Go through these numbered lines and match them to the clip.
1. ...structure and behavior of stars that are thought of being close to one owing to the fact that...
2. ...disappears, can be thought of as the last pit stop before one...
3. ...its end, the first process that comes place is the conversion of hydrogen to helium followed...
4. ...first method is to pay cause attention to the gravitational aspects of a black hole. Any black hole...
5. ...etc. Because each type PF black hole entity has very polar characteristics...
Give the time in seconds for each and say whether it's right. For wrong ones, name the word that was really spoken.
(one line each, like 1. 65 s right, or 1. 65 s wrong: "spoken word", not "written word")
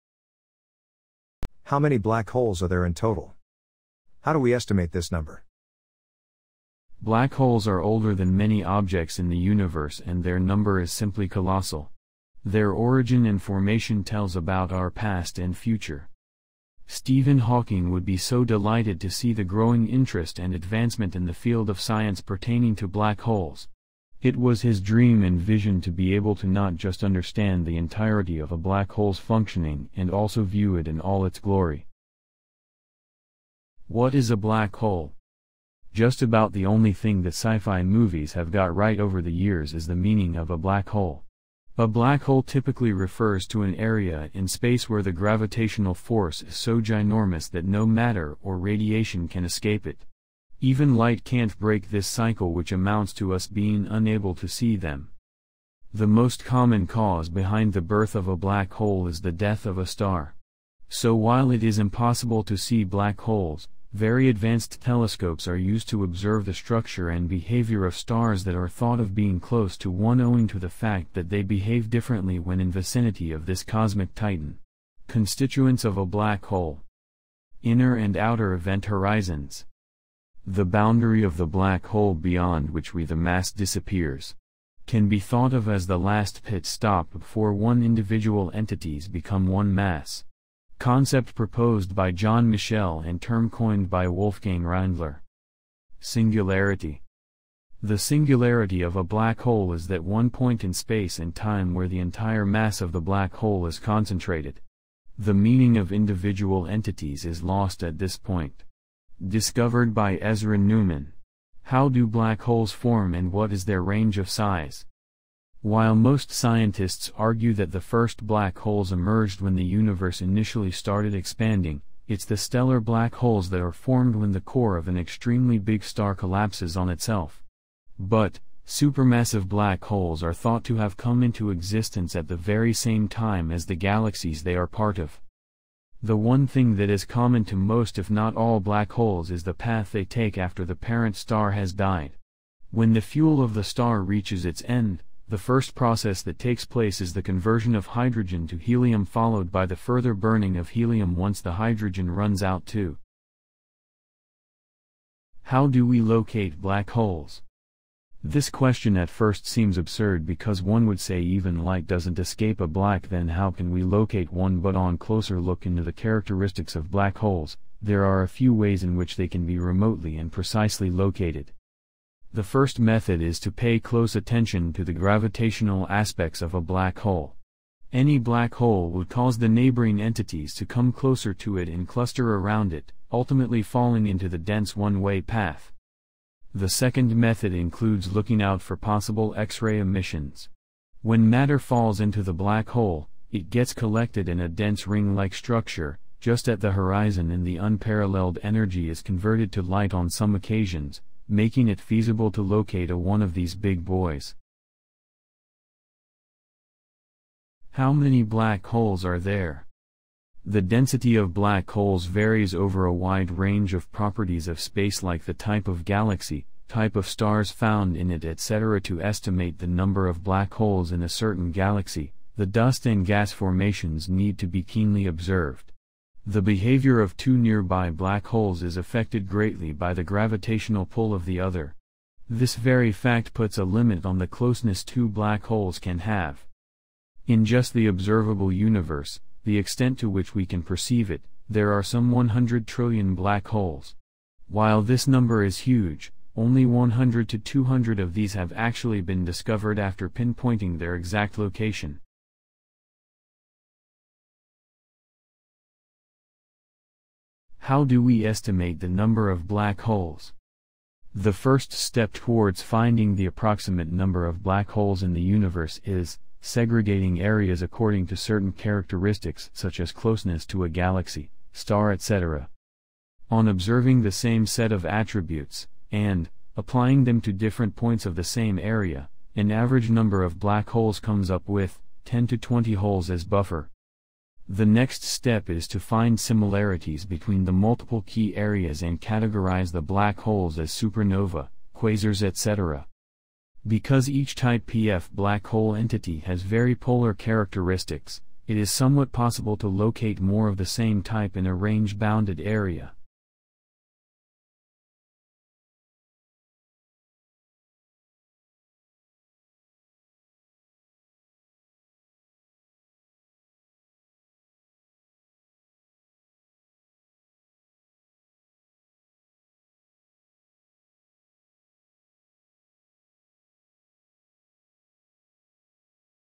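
1. 66 s right
2. 83 s right
3. 144 s wrong: "takes", not "comes"
4. 172 s wrong: "close", not "cause"
5. 292 s right.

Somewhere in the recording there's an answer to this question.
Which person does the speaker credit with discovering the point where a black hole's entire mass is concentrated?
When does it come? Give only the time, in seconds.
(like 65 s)
110 s.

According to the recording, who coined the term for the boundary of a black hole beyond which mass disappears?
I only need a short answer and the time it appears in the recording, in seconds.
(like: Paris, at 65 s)
Wolfgang Rindler, at 94 s.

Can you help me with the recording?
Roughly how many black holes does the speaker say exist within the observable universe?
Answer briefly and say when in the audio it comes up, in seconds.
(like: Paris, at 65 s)
100 trillion, at 242 s.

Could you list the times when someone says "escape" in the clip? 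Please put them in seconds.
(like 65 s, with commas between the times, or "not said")
49 s, 162 s.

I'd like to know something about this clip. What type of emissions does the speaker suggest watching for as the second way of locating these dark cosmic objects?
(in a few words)
X-ray emissions.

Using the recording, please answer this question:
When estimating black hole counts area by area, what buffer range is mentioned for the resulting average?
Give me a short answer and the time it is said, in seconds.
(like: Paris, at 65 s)
10 to 20, at 282 s.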